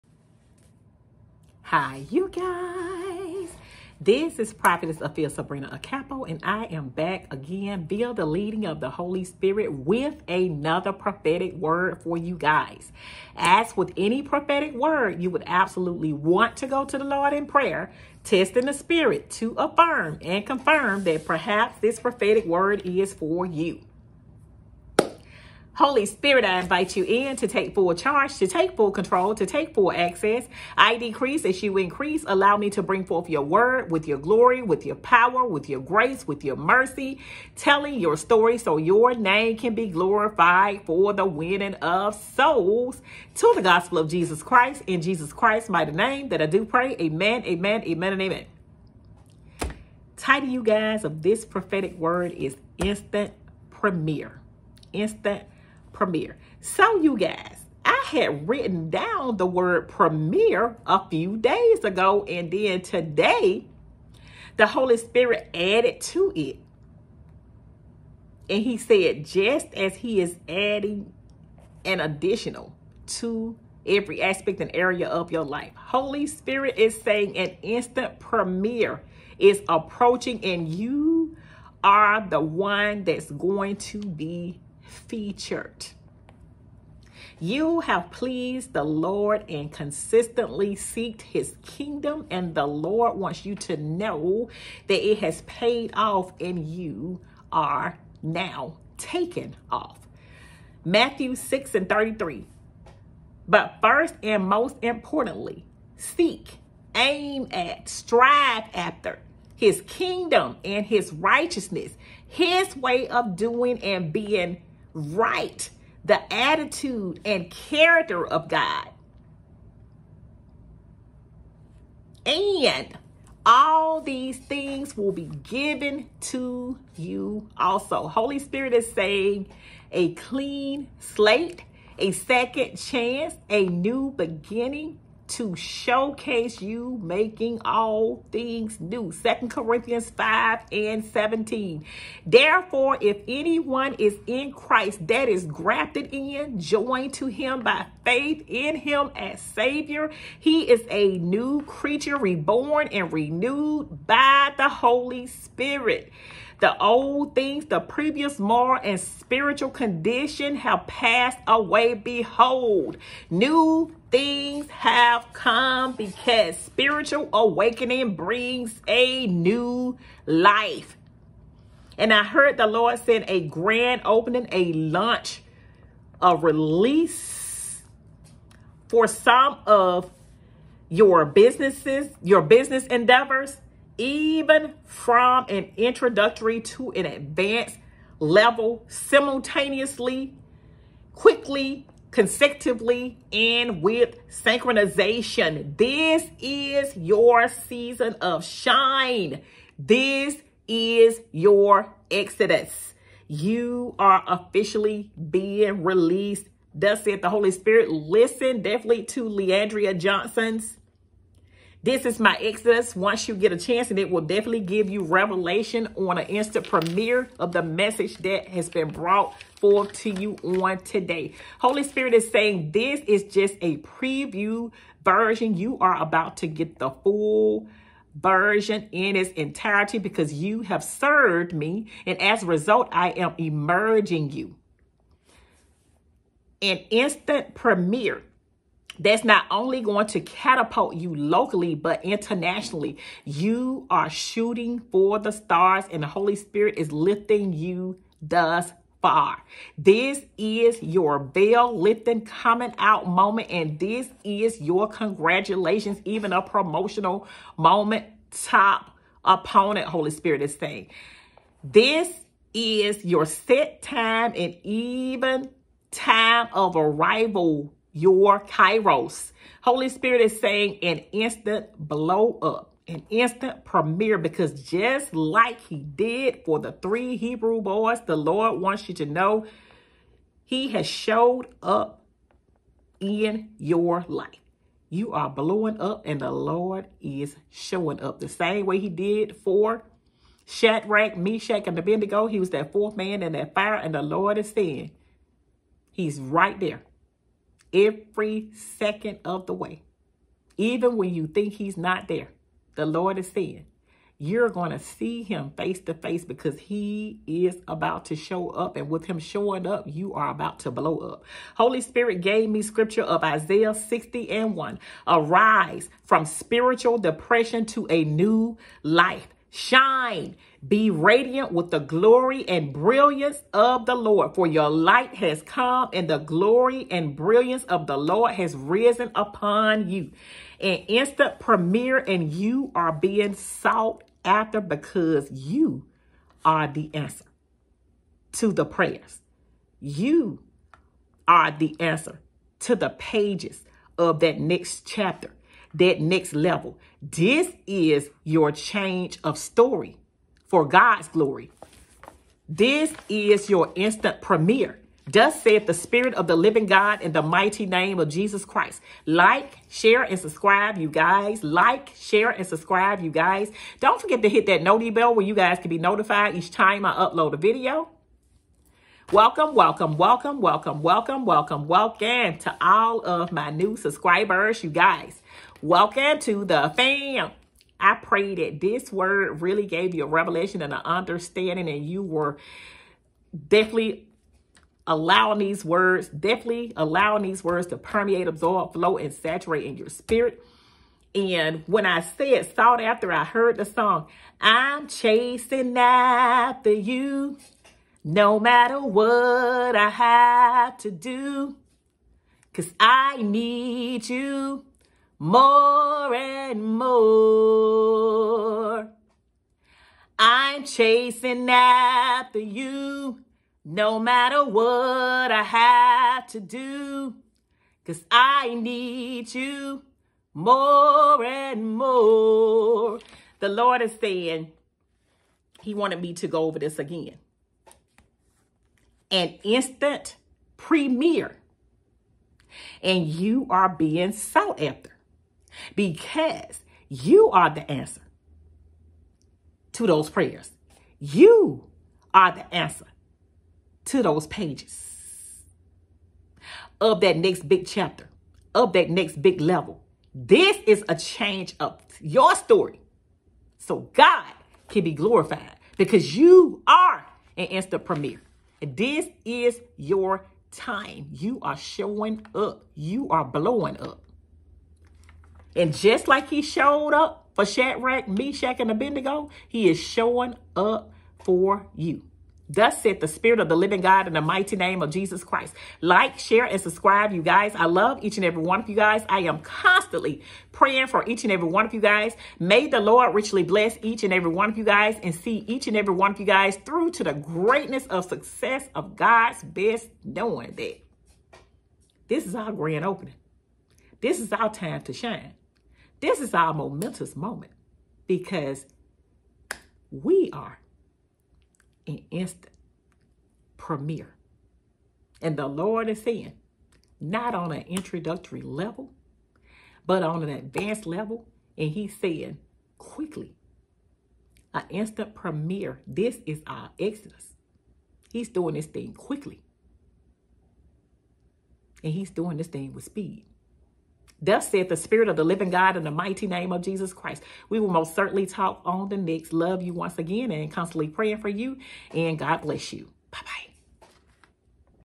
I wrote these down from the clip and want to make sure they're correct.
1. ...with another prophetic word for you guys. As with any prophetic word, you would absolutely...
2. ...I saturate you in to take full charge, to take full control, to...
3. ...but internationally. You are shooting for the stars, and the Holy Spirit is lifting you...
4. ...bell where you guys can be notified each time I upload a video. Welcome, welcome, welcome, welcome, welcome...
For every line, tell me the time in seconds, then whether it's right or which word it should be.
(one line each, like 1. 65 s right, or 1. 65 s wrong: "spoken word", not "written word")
1. 9 s right
2. 26 s wrong: "invite", not "saturate"
3. 241 s right
4. 364 s right.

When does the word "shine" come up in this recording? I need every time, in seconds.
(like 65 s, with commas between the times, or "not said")
198 s, 319 s, 494 s.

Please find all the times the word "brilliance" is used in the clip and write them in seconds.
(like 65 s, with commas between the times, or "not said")
322 s, 327 s.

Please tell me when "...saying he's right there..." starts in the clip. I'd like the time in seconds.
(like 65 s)
294 s.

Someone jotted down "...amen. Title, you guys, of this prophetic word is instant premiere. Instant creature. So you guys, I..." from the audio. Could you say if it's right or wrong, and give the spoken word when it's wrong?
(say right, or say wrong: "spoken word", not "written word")
wrong: "premiere", not "creature".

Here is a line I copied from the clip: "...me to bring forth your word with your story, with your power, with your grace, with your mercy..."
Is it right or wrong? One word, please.
wrong.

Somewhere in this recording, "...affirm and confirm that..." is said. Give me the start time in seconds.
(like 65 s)
19 s.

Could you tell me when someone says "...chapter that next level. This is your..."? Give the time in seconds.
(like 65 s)
344 s.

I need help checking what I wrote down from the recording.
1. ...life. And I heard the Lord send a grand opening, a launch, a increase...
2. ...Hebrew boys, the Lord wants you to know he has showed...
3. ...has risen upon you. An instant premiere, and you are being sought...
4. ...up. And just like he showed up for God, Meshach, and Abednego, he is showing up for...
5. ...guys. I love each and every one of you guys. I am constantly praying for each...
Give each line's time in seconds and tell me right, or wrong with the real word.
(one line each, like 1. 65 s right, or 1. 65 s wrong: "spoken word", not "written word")
1. 170 s wrong: "release", not "increase"
2. 277 s right
3. 328 s right
4. 463 s wrong: "Shadrach", not "God"
5. 477 s right.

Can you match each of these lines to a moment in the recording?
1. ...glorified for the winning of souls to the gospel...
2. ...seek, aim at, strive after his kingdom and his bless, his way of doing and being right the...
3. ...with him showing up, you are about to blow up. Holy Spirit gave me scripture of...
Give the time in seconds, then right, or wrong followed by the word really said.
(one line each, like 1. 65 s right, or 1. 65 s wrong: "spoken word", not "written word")
1. 39 s right
2. 105 s wrong: "righteousness", not "bless"
3. 308 s right.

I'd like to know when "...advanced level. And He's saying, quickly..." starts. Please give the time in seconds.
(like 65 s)
510 s.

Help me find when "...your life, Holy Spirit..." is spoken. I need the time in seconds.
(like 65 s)
75 s.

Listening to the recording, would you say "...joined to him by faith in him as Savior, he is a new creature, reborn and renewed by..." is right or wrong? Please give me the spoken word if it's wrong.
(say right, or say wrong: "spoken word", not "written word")
right.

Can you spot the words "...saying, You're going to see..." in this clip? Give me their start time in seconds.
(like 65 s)
303 s.